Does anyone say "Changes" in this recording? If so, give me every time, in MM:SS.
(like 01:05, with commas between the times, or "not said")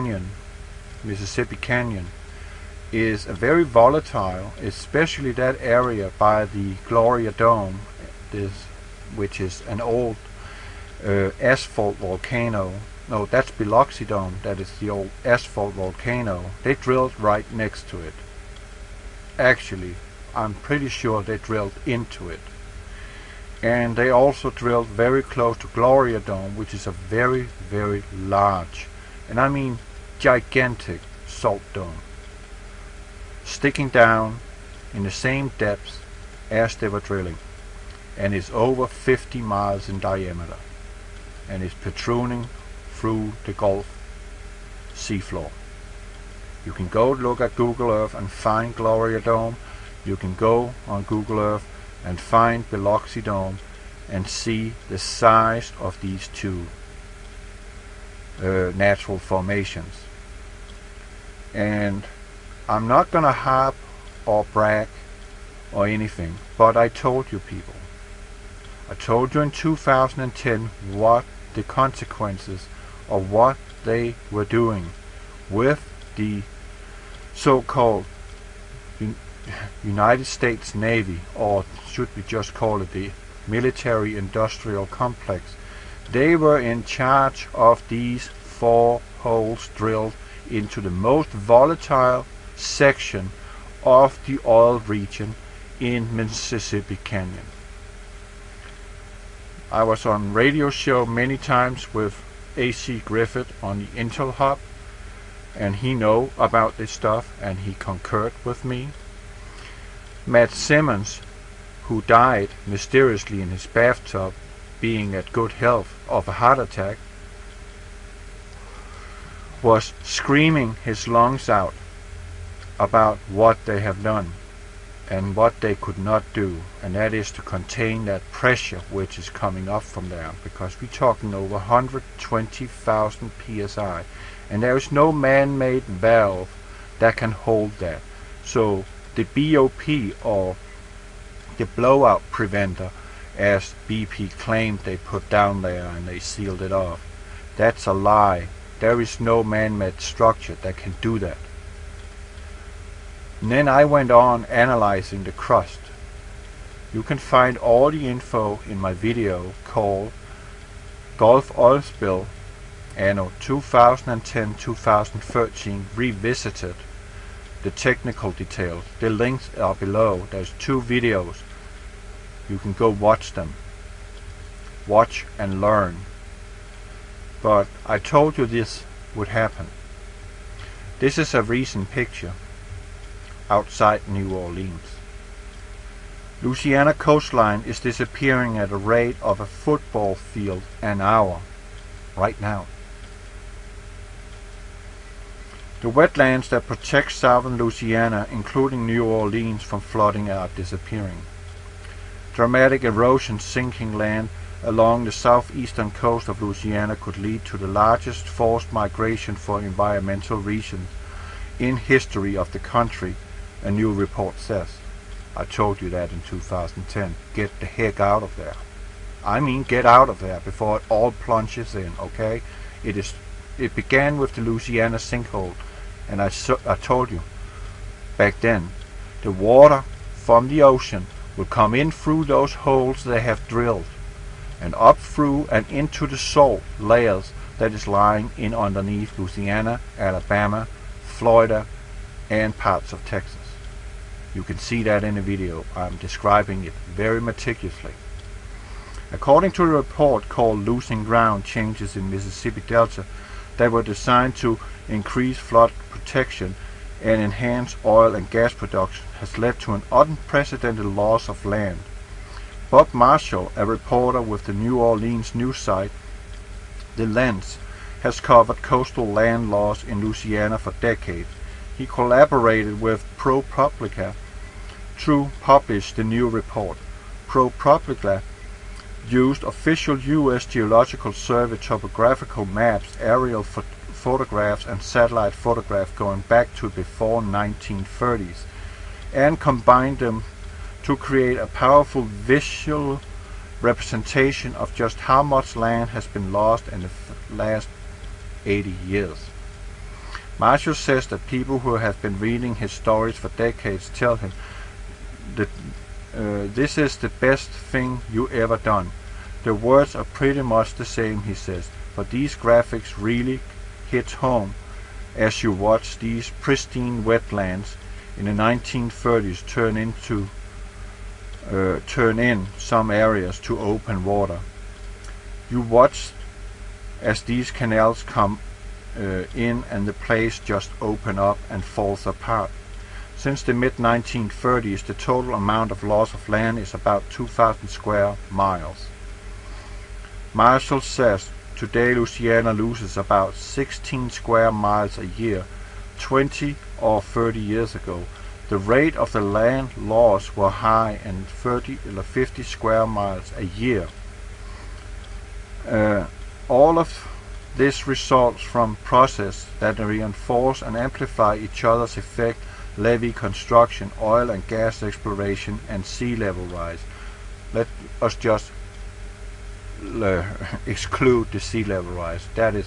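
04:11.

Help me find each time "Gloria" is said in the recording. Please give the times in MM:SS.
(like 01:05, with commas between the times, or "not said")
00:06, 00:25, 00:48.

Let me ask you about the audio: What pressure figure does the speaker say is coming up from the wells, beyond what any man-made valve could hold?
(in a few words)
over 120,000 psi.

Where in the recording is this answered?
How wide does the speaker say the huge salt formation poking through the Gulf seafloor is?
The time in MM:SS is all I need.
00:38.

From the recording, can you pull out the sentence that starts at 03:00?
This is a recent picture outside New Orleans.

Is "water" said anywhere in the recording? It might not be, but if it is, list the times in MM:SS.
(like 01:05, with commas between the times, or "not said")
03:49, 05:24.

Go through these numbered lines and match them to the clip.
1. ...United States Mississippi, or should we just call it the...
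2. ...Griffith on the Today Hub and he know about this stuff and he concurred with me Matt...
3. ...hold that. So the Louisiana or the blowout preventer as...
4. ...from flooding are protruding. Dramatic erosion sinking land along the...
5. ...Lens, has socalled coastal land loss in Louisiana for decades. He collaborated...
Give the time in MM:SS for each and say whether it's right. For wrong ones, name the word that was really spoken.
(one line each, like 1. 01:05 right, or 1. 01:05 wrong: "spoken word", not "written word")
1. 01:19 wrong: "Navy", not "Mississippi"
2. 01:43 wrong: "Intel", not "Today"
3. 02:17 wrong: "BOP", not "Louisiana"
4. 03:19 wrong: "disappearing", not "protruding"
5. 04:27 wrong: "covered", not "socalled".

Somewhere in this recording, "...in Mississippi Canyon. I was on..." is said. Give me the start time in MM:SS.
01:35.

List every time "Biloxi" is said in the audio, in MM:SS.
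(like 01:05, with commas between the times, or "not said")
00:13, 00:52.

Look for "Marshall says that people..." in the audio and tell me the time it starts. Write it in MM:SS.
05:00.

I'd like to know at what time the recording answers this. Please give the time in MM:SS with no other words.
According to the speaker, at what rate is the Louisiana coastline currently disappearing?
03:09.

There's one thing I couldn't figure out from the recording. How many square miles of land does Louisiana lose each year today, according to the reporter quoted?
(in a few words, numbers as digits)
16 square miles.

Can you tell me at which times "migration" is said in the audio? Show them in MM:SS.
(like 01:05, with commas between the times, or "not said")
03:28.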